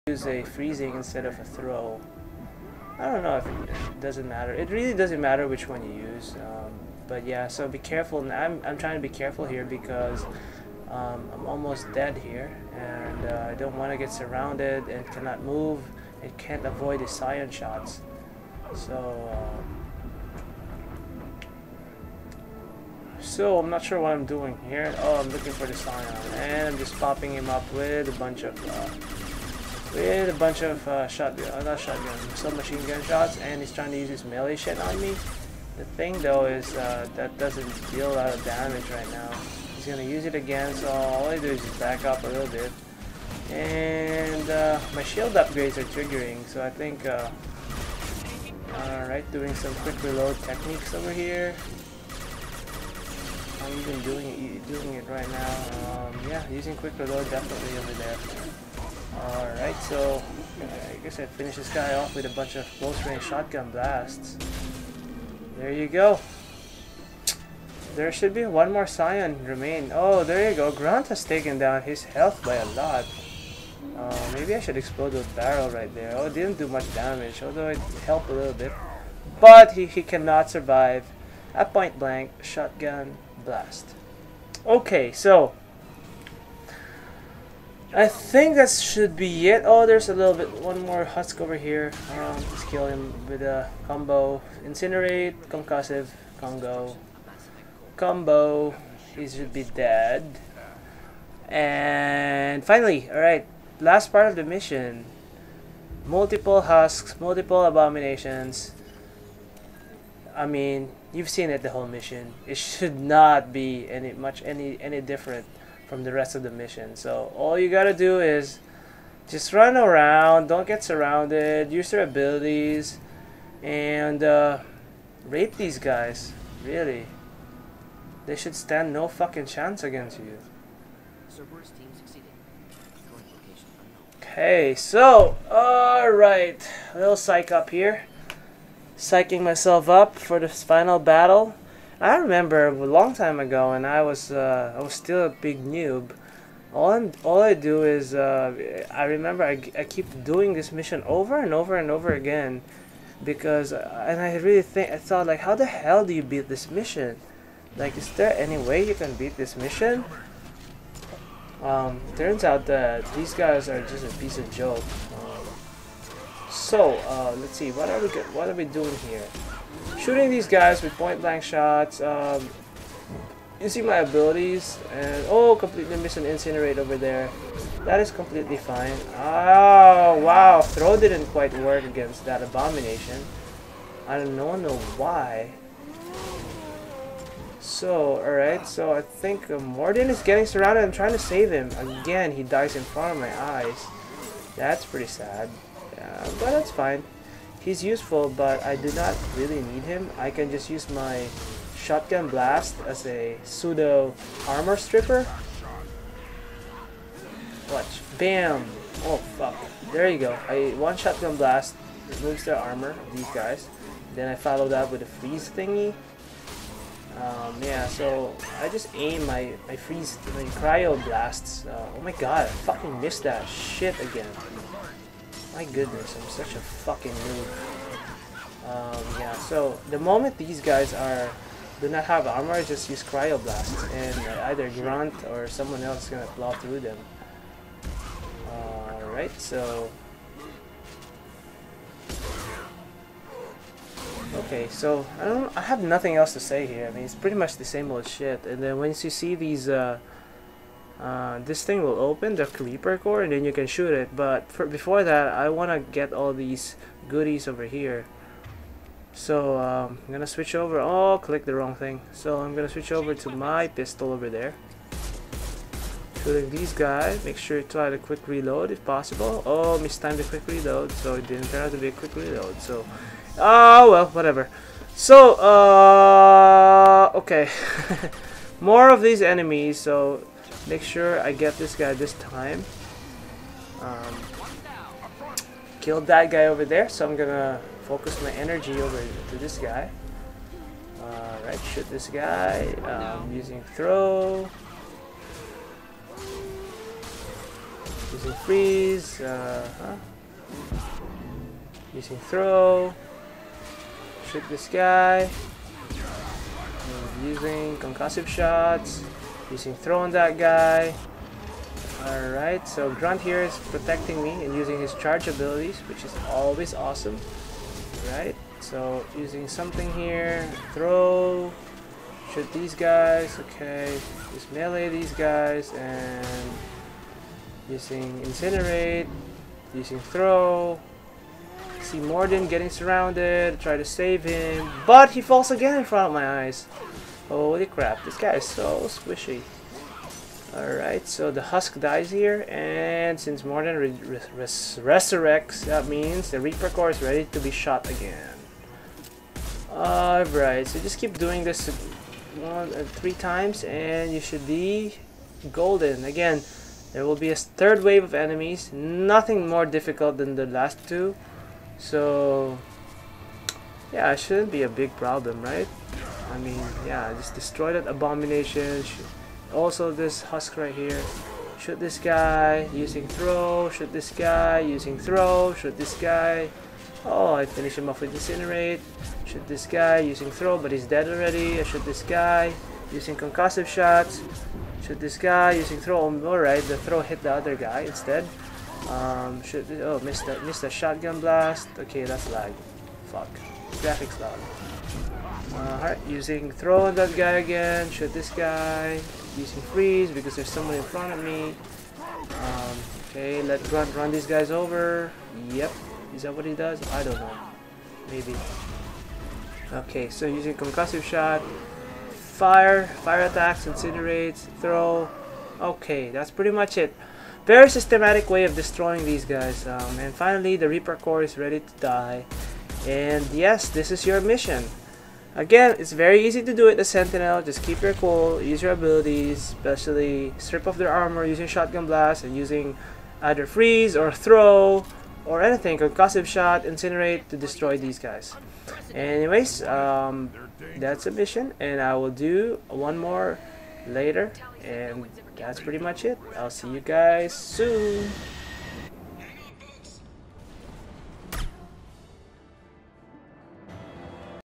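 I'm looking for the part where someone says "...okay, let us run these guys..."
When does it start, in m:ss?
6:43.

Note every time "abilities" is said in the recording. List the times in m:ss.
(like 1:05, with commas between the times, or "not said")
2:02, 2:53, 5:15, 7:08.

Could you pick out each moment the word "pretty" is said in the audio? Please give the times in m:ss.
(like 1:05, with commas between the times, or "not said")
3:14, 4:07, 6:56, 7:25.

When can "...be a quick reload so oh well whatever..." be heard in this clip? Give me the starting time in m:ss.
4:31.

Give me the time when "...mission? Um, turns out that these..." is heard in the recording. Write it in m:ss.
2:39.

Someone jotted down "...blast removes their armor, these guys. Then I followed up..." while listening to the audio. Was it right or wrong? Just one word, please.
right.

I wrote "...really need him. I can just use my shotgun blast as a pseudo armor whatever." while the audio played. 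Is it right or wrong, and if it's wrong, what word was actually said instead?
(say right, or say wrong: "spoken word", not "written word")
wrong: "stripper", not "whatever".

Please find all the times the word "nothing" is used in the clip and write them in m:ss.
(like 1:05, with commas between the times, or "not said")
4:05, 5:58.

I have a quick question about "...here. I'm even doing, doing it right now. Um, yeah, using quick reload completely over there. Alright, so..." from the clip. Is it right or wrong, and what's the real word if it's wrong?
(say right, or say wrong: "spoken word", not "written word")
wrong: "definitely", not "completely".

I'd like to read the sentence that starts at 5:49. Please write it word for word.
Alright, so just keep doing this one, uh, three times, and you should be golden.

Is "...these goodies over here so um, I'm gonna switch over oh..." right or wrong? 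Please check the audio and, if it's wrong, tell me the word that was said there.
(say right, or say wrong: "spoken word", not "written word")
right.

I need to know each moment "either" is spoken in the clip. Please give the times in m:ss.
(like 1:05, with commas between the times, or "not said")
3:54, 7:13.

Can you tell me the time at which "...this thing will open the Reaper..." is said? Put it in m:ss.
4:11.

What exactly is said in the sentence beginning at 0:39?
He's gonna use it again, so all I do is just back up a little bit.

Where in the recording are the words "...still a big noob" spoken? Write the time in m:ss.
2:24.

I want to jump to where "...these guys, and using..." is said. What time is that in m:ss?
5:24.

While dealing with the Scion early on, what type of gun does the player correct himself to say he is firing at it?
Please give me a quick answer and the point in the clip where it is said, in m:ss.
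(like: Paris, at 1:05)
submachine gun, at 0:32.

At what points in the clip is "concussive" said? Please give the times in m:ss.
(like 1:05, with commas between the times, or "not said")
1:35, 5:07, 6:23, 6:50, 7:15.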